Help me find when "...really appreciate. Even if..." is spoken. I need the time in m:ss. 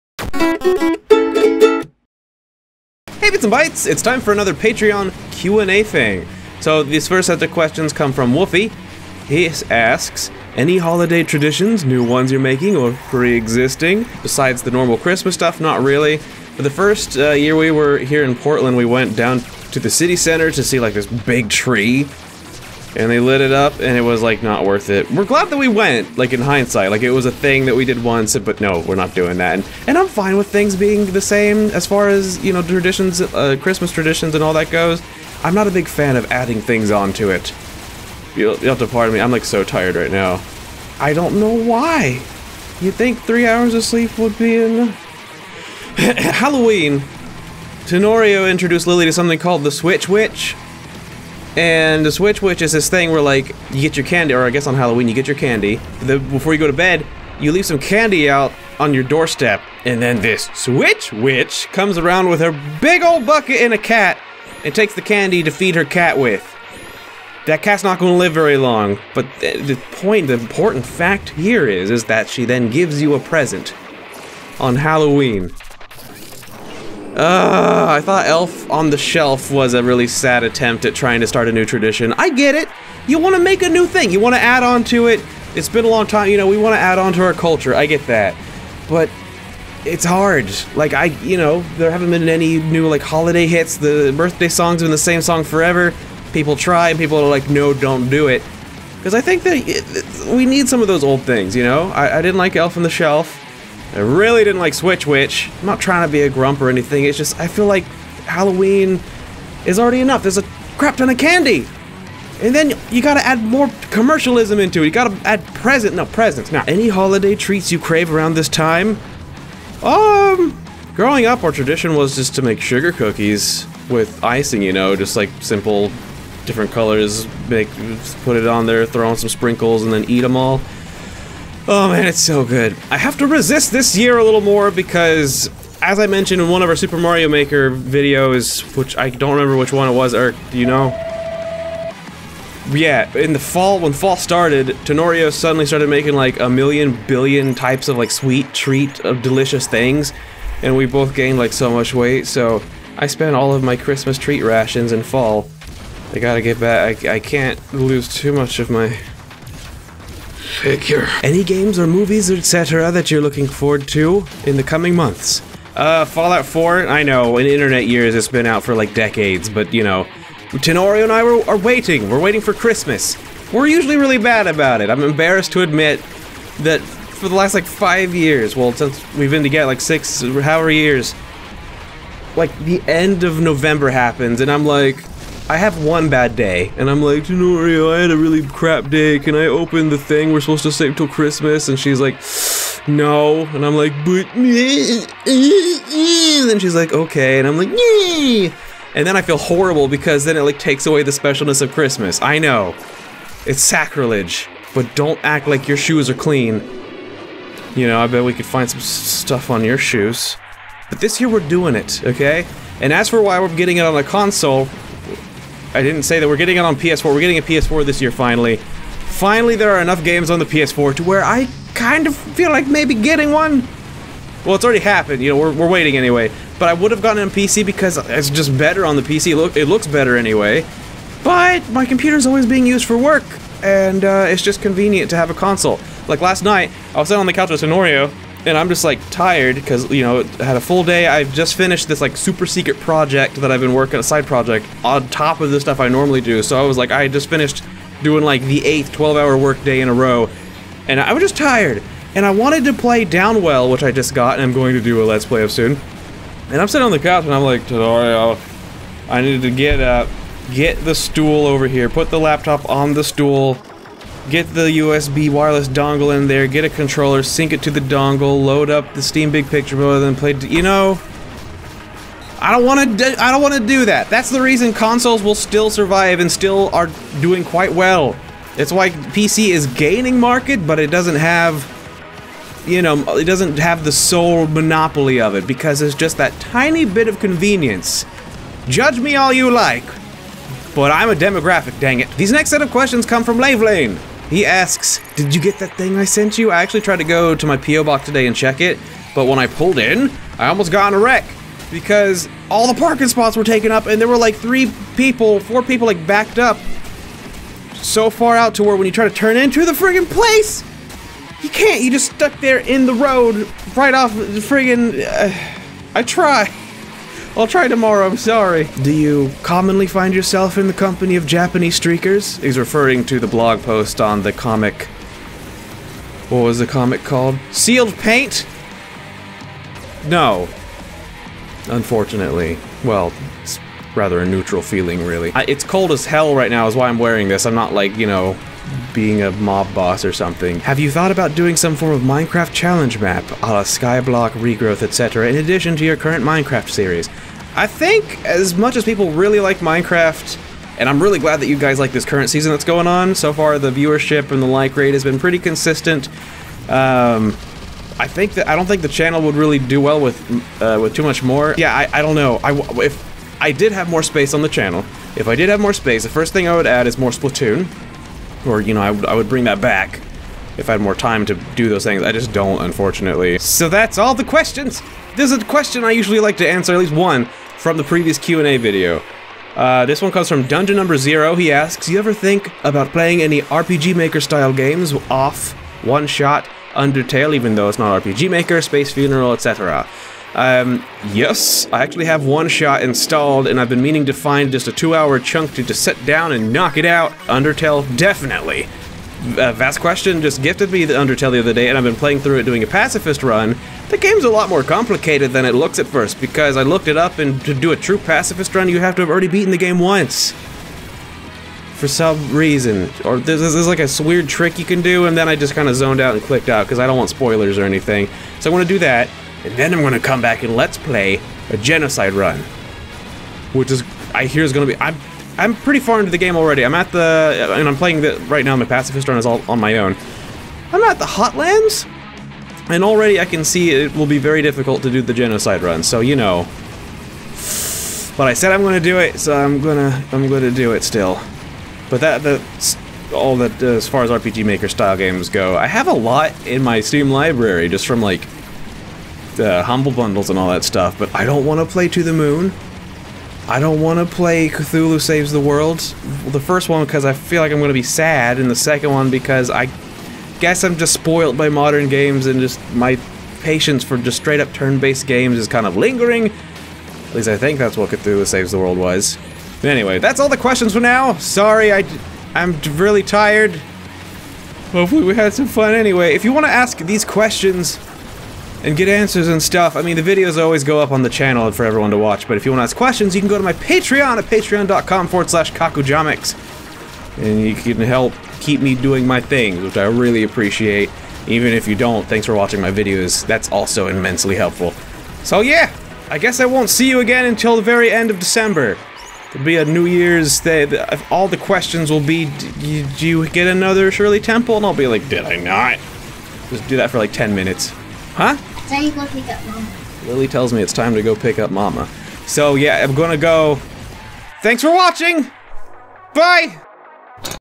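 8:09.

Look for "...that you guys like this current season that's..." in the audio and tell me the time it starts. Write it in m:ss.
5:51.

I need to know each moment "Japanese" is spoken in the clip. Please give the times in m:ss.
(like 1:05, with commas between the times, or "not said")
5:21.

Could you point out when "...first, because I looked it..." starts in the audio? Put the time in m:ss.
6:45.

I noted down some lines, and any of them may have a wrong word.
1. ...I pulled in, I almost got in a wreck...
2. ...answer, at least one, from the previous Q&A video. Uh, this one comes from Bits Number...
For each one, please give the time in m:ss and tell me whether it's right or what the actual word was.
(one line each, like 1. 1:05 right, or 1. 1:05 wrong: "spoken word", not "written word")
1. 4:59 right
2. 6:16 wrong: "Dungeon", not "Bits".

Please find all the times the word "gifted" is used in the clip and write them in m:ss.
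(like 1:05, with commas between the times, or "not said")
6:40.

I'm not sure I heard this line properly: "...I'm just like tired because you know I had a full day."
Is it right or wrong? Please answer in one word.
right.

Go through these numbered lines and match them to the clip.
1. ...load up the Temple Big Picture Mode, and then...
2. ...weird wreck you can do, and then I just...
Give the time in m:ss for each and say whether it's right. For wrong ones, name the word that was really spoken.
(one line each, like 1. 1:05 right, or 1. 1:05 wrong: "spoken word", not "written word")
1. 4:28 wrong: "Steam", not "Temple"
2. 6:54 wrong: "trick", not "wreck".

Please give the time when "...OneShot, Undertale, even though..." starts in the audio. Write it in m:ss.
6:25.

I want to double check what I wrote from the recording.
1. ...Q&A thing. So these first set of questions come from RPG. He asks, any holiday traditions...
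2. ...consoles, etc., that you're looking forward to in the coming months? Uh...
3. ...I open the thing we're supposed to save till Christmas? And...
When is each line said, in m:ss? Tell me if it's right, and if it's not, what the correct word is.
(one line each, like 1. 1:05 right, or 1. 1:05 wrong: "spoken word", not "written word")
1. 0:05 wrong: "Wolfie", not "RPG"
2. 2:41 wrong: "movies", not "consoles"
3. 3:09 right.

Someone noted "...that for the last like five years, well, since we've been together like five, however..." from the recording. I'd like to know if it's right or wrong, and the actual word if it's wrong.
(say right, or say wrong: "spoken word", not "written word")
wrong: "six", not "five".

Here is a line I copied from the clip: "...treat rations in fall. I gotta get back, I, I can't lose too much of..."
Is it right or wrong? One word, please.
right.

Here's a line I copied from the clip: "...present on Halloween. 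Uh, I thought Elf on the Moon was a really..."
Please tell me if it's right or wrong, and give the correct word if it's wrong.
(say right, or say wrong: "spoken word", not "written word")
wrong: "Shelf", not "Moon".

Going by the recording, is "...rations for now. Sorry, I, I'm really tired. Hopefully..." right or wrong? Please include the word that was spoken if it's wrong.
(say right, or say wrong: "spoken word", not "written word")
wrong: "questions", not "rations".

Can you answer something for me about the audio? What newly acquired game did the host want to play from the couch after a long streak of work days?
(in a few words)
Downwell.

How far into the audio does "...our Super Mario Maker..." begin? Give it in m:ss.
2:16.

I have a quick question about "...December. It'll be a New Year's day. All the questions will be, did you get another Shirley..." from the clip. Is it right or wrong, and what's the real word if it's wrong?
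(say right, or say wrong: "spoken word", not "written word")
right.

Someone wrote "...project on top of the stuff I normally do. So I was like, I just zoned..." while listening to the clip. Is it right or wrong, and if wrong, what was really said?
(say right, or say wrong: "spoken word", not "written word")
wrong: "finished", not "zoned".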